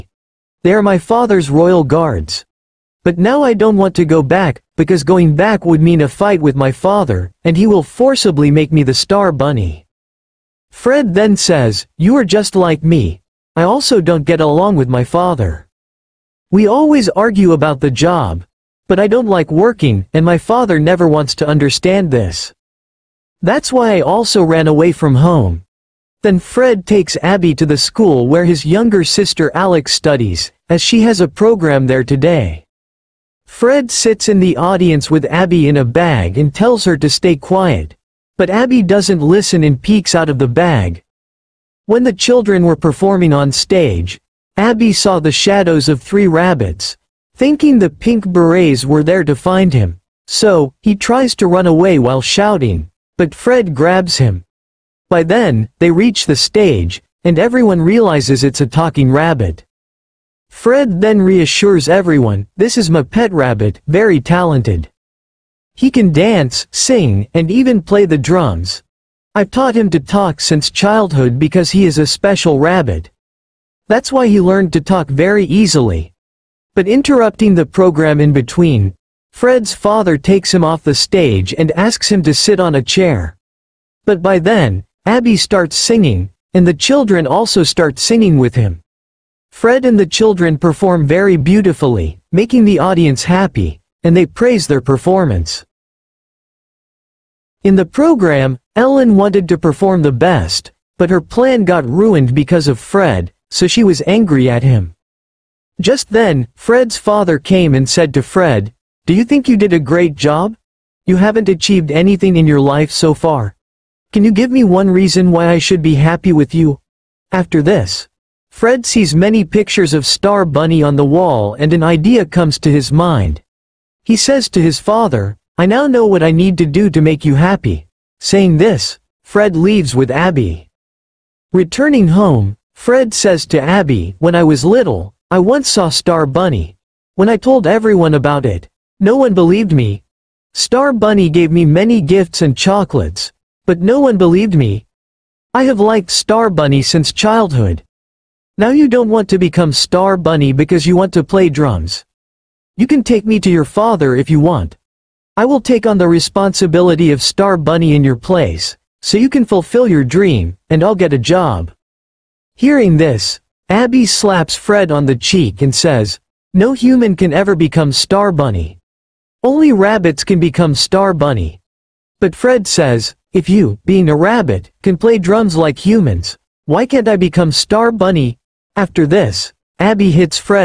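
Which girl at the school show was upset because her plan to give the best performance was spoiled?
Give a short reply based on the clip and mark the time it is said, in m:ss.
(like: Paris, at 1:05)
Ellen, at 1:38.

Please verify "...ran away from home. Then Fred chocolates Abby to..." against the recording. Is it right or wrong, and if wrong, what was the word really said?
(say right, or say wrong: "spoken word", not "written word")
wrong: "takes", not "chocolates".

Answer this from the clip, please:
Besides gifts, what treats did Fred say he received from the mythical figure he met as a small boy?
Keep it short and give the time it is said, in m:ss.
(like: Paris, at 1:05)
chocolates, at 2:22.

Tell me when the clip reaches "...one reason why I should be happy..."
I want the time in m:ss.
1:54.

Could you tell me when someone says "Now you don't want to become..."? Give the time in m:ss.
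2:28.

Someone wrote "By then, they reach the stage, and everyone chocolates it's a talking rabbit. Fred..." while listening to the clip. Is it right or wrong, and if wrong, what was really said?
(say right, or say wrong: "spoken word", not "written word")
wrong: "realizes", not "chocolates".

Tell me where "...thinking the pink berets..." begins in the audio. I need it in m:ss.
0:47.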